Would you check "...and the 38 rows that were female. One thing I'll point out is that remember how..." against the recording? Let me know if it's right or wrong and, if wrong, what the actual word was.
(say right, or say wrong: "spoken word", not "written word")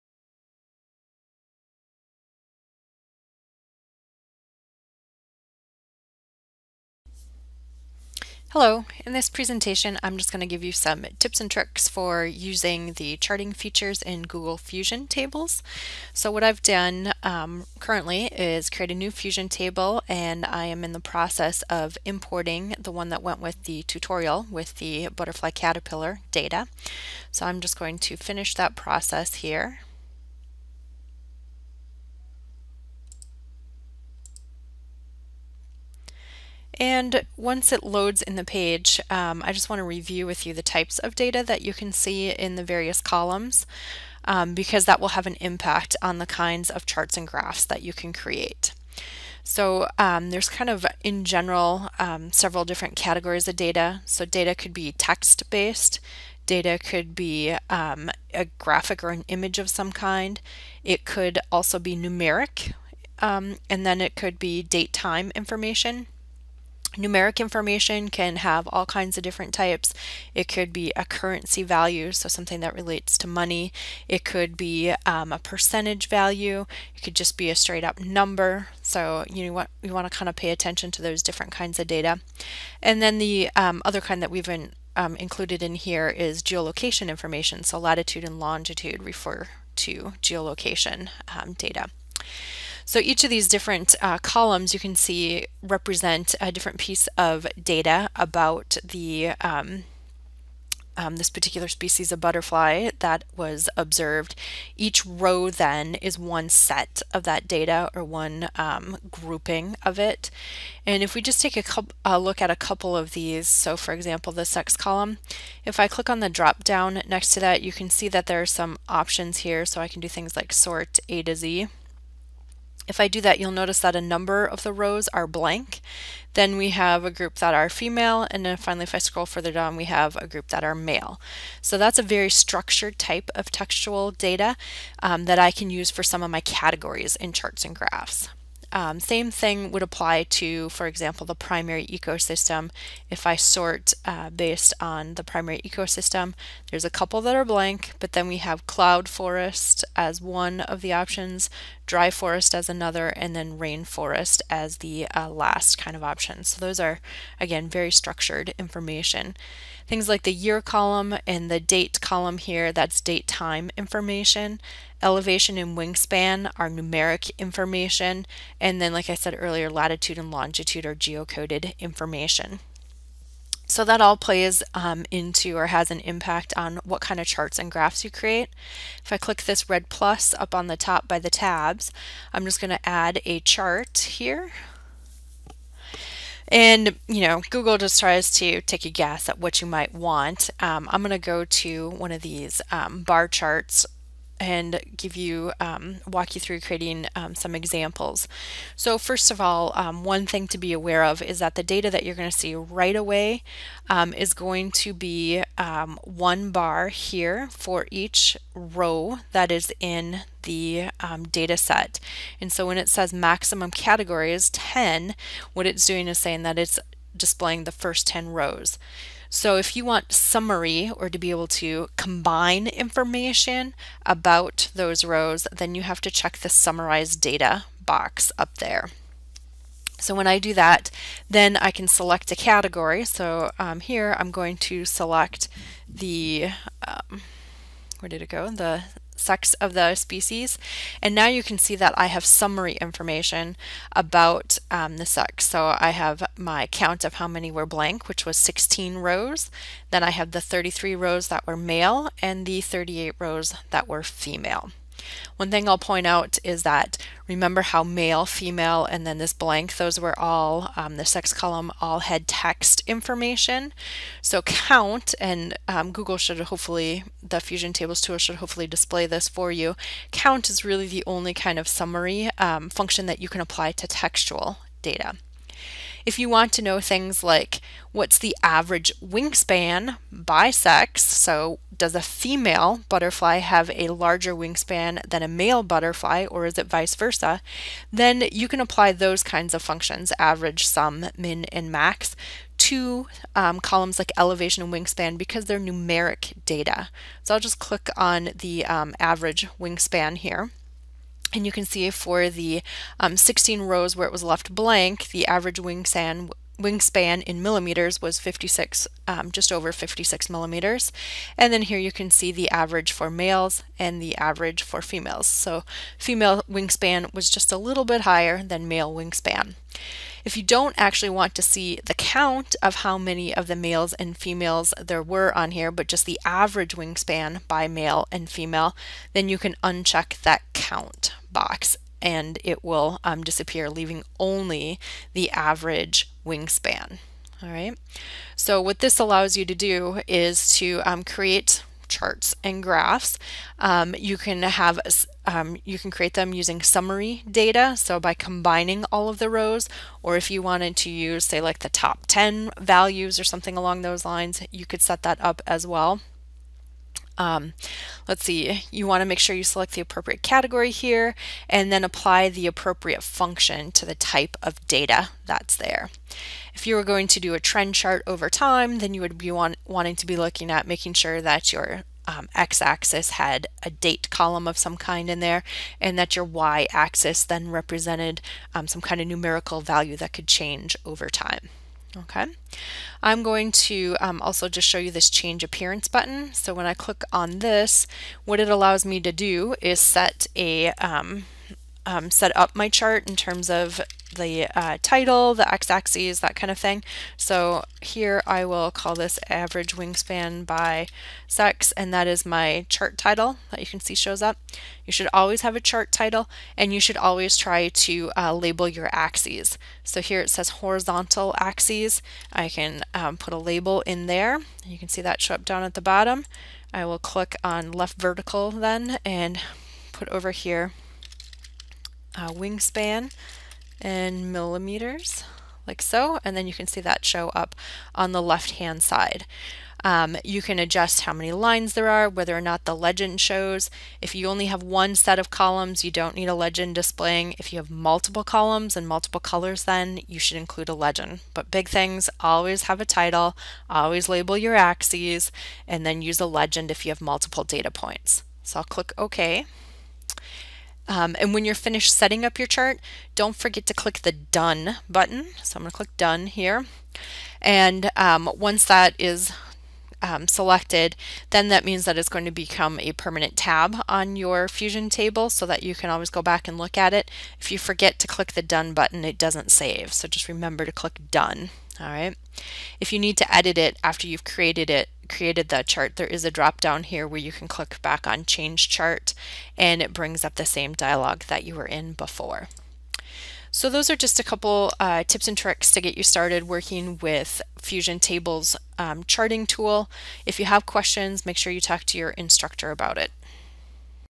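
right.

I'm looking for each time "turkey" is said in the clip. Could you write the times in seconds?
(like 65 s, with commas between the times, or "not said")
not said.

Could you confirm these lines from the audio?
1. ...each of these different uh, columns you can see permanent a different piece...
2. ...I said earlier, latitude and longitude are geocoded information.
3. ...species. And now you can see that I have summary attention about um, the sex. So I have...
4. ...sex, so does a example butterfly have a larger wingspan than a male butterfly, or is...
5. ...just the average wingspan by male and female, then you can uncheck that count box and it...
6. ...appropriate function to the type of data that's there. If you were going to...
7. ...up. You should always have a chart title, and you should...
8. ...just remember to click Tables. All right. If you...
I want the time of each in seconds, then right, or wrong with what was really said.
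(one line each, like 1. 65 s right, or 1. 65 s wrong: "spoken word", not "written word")
1. 92 s wrong: "represent", not "permanent"
2. 169 s right
3. 239 s wrong: "information", not "attention"
4. 280 s wrong: "female", not "example"
5. 325 s right
6. 362 s right
7. 404 s right
8. 470 s wrong: "Done", not "Tables".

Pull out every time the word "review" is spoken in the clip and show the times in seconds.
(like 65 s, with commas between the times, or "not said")
39 s.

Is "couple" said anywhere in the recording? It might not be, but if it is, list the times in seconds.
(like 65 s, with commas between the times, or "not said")
112 s, 146 s, 484 s.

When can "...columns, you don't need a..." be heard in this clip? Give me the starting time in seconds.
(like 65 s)
435 s.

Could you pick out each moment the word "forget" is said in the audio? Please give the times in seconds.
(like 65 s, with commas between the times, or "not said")
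453 s, 467 s.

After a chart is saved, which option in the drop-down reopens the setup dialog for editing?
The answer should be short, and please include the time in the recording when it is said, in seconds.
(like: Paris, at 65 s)
change chart, at 478 s.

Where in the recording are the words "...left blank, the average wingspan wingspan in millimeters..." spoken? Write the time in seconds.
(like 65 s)
304 s.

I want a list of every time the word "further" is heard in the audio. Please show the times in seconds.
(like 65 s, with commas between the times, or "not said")
129 s.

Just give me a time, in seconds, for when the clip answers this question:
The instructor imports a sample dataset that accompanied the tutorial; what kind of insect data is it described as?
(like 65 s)
25 s.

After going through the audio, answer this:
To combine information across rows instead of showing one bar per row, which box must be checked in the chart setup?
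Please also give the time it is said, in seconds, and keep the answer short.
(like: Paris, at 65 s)
summarize data, at 226 s.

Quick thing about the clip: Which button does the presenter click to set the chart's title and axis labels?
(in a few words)
change appearance.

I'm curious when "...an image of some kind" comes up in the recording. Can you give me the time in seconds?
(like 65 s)
59 s.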